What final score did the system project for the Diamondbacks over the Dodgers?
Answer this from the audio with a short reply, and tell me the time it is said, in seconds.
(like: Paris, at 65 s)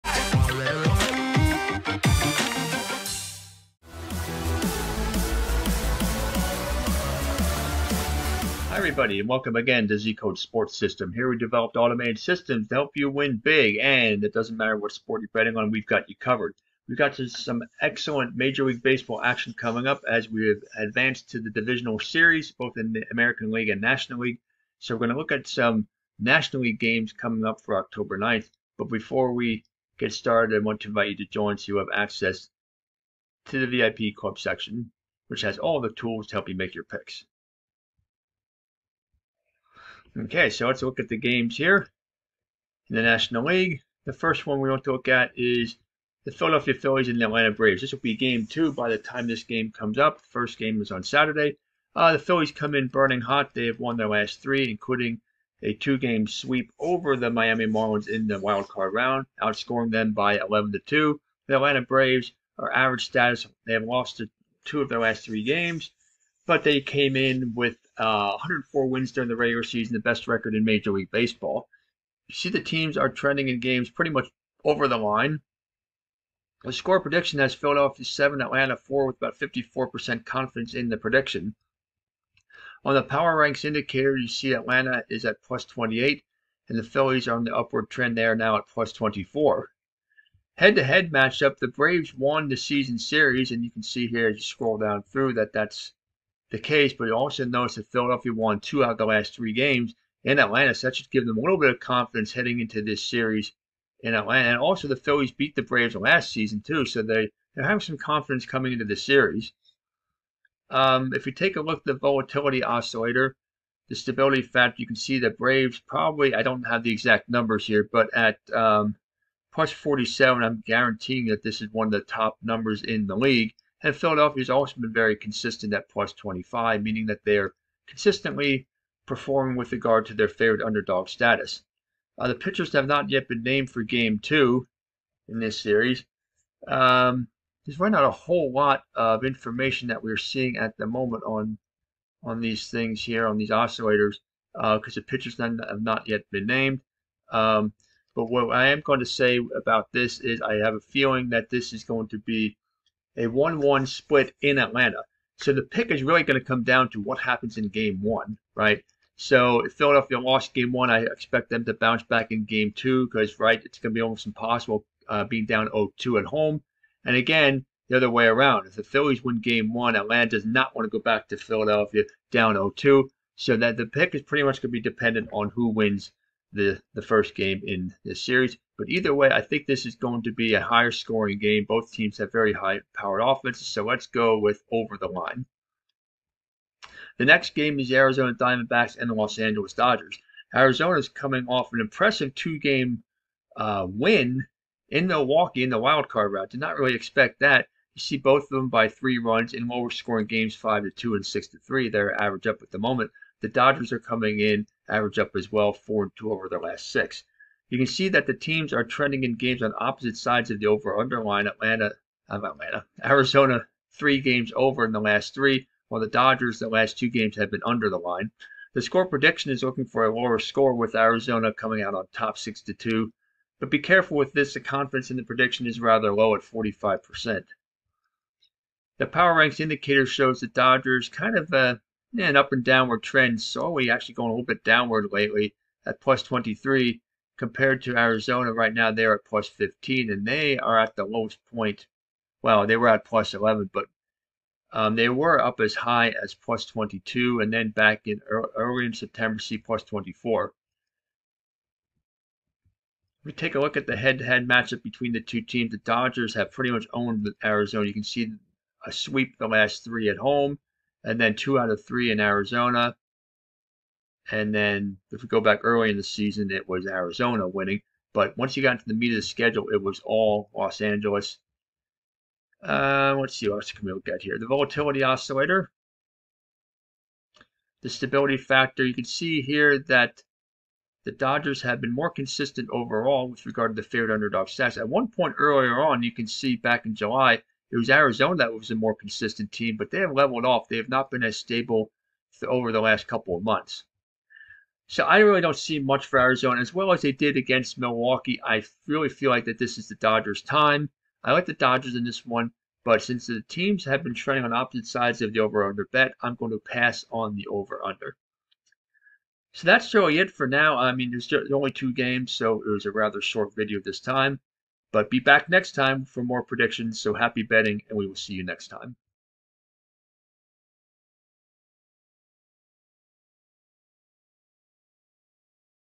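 6-2, at 222 s.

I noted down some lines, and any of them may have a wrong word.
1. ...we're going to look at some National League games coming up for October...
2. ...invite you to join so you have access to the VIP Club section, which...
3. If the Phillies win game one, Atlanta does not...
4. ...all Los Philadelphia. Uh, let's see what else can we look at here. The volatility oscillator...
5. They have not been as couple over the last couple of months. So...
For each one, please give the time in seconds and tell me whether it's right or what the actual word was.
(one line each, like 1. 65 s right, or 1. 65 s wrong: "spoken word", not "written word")
1. 24 s right
2. 30 s right
3. 168 s right
4. 270 s wrong: "Angeles", not "Philadelphia"
5. 290 s wrong: "stable", not "couple".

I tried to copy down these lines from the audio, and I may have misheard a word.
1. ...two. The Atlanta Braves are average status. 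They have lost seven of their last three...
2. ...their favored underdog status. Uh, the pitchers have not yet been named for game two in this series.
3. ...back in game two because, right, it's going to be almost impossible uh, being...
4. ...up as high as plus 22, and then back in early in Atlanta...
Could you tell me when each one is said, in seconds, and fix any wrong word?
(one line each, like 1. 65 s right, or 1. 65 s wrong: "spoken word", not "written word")
1. 60 s wrong: "two", not "seven"
2. 130 s right
3. 162 s right
4. 245 s wrong: "September", not "Atlanta".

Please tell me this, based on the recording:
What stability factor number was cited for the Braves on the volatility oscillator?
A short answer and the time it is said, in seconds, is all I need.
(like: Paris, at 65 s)
+47, at 119 s.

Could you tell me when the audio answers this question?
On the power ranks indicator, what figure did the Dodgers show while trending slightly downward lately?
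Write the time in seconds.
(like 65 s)
236 s.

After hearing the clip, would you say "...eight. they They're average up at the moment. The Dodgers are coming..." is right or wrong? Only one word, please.
wrong.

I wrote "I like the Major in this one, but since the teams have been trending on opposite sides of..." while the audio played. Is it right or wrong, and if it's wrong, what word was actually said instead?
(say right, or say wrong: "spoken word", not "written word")
wrong: "Dodgers", not "Major".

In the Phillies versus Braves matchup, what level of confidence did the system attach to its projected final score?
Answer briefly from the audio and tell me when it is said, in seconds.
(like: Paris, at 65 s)
54%, at 79 s.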